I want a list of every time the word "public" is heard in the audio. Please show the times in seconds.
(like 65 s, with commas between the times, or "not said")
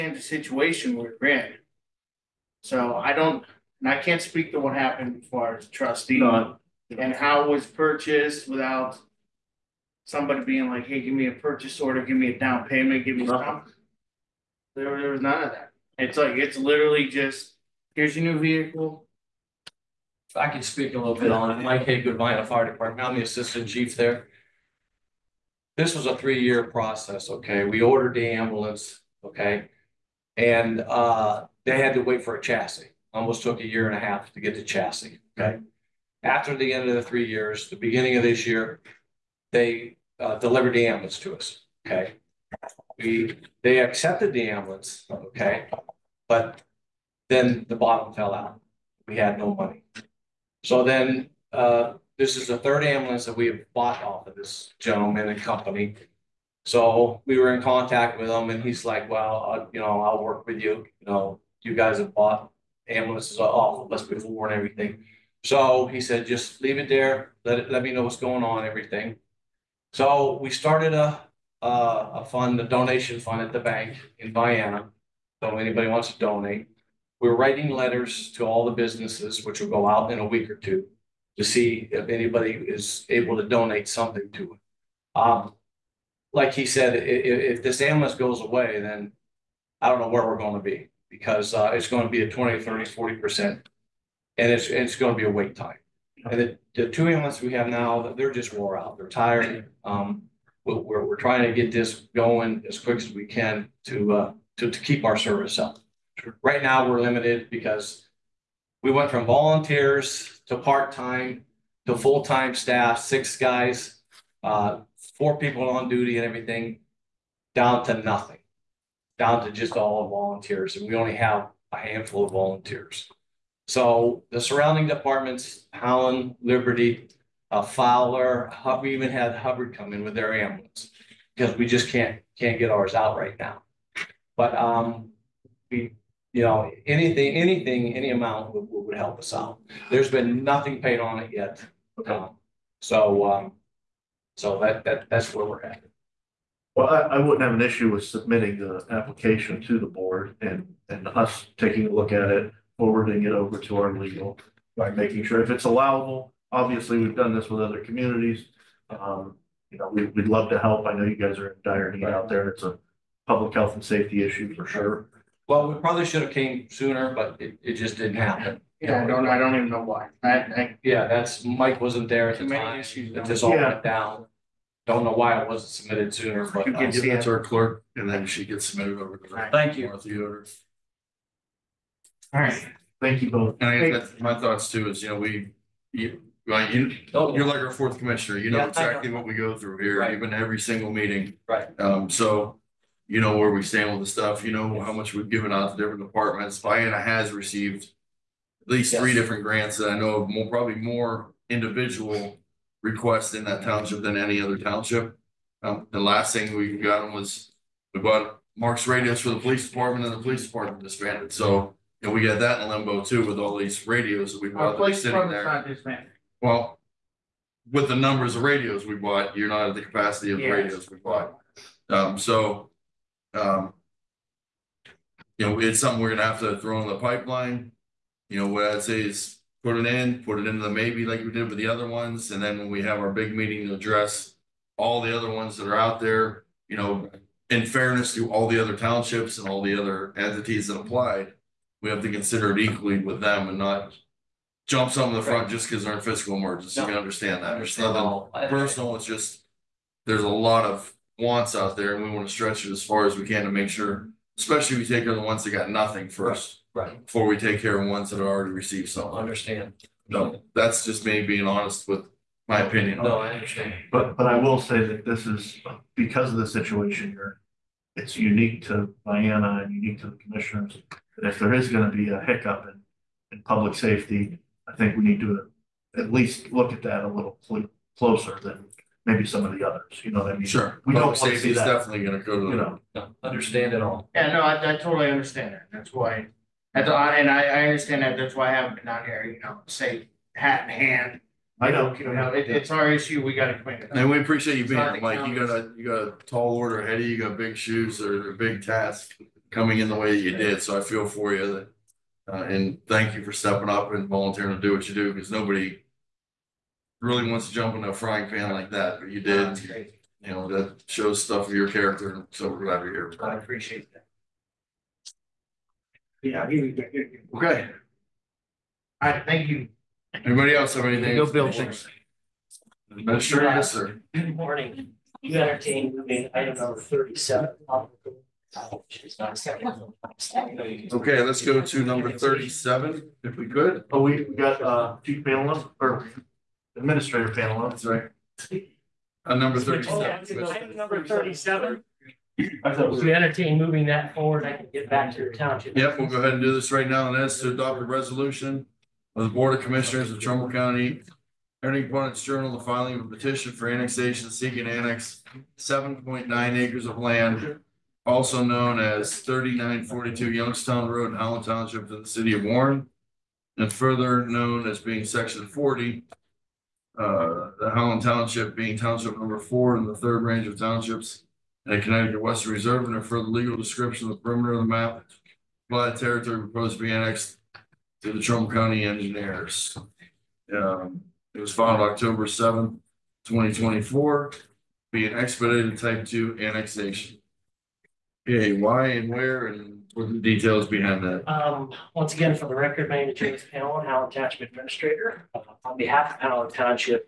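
163 s, 273 s, 281 s.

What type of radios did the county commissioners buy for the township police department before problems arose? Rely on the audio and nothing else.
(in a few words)
MARCS radios.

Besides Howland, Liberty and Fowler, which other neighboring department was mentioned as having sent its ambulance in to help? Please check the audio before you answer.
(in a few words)
Hubbard.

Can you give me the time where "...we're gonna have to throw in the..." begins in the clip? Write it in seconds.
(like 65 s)
225 s.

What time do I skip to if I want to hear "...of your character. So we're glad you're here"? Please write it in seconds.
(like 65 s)
311 s.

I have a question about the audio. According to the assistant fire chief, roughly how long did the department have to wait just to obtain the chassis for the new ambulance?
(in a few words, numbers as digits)
a year and a half.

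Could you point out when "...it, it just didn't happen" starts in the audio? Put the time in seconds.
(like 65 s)
167 s.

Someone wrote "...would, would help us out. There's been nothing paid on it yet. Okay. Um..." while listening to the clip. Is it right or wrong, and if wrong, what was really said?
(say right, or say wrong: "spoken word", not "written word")
right.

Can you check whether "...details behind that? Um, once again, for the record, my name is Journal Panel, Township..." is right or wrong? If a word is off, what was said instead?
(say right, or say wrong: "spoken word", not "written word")
wrong: "James", not "Journal".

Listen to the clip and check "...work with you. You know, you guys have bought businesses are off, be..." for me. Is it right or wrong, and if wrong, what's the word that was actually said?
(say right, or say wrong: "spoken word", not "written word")
wrong: "ambulances", not "businesses".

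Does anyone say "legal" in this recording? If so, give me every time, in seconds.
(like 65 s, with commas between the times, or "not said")
153 s, 373 s.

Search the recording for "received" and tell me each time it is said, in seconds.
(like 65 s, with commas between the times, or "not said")
197 s, 258 s.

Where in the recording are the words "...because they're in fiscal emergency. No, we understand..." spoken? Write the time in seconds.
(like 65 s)
245 s.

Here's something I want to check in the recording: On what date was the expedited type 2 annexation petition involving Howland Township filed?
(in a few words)
October 7, 2024.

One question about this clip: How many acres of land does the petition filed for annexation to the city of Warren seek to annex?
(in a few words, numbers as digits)
7.9 acres.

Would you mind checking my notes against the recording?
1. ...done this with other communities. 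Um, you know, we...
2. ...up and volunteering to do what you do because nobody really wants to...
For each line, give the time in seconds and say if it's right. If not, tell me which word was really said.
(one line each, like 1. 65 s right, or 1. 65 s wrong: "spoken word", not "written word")
1. 157 s right
2. 303 s right.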